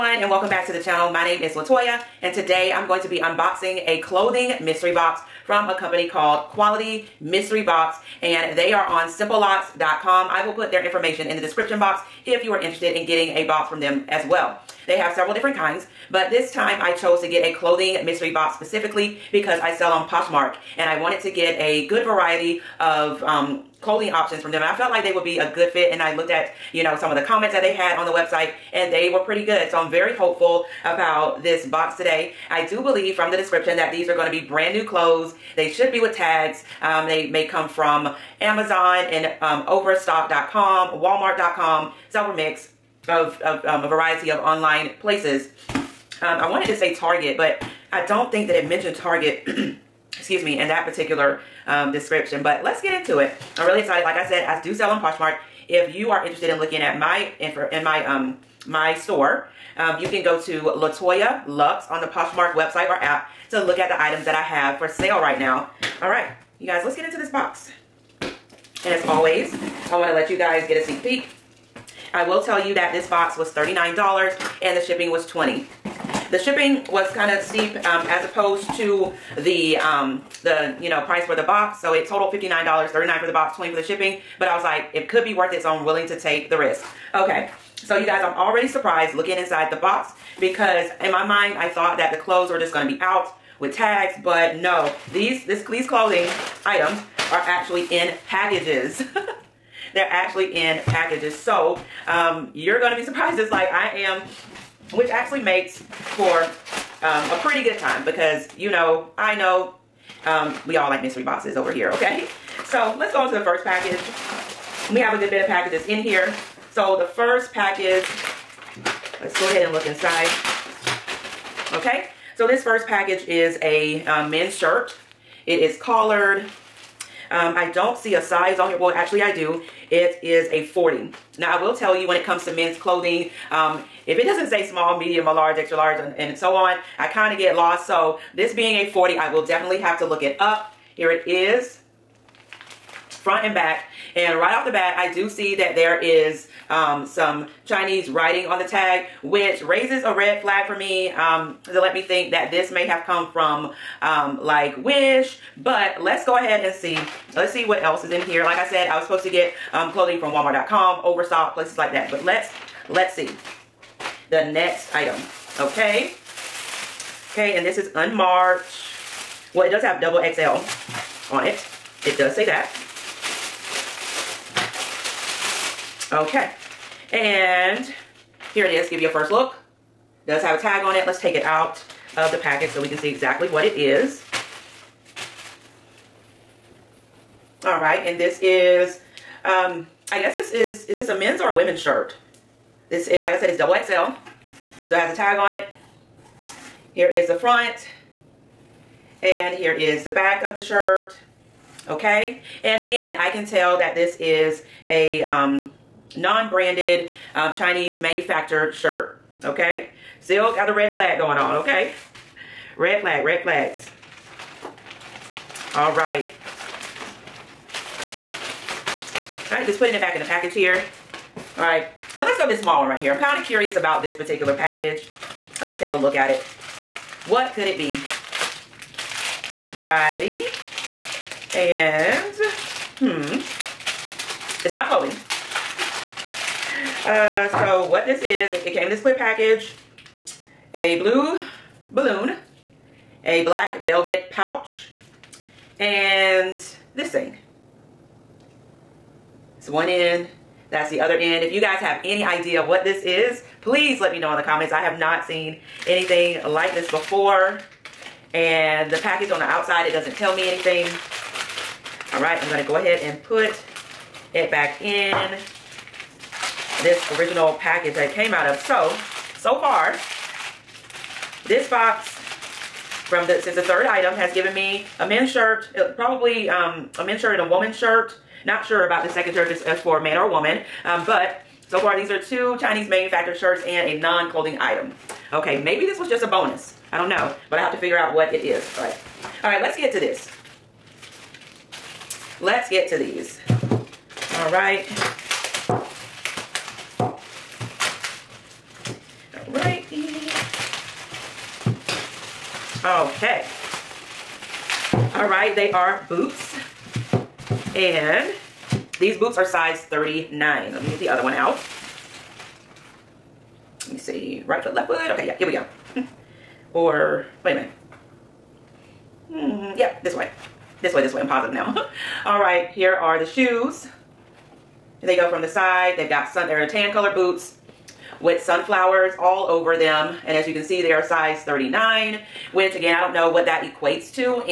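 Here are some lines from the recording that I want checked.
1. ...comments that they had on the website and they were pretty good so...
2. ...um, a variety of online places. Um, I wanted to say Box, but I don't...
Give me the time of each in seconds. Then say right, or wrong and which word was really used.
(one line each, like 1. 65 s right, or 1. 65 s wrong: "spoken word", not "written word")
1. 27 s right
2. 43 s wrong: "Target", not "Box".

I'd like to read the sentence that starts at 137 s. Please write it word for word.
So this being a 40, I will definitely have to look it up.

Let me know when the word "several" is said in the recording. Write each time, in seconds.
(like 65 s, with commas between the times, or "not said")
15 s, 42 s.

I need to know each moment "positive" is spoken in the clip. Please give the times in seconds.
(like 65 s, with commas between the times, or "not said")
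321 s.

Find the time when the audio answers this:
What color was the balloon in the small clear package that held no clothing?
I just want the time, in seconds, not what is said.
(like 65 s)
240 s.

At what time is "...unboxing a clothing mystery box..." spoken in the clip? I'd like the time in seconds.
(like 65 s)
3 s.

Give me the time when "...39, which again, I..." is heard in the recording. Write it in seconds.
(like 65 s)
331 s.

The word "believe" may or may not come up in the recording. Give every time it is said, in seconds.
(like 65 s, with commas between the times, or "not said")
32 s.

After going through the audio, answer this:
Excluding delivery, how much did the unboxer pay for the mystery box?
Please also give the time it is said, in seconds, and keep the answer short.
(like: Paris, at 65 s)
$39, at 72 s.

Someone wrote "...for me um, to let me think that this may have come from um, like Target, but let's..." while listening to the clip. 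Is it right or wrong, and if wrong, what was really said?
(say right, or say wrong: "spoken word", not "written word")
wrong: "Wish", not "Target".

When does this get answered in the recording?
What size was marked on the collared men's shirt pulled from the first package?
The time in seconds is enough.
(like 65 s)
129 s.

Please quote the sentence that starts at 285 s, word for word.
Okay, maybe this was just a bonus.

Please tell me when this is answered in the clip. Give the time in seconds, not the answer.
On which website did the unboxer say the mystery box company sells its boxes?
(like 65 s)
9 s.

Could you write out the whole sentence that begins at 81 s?
So it totaled $59, 39 for the box, 20 for the shipping.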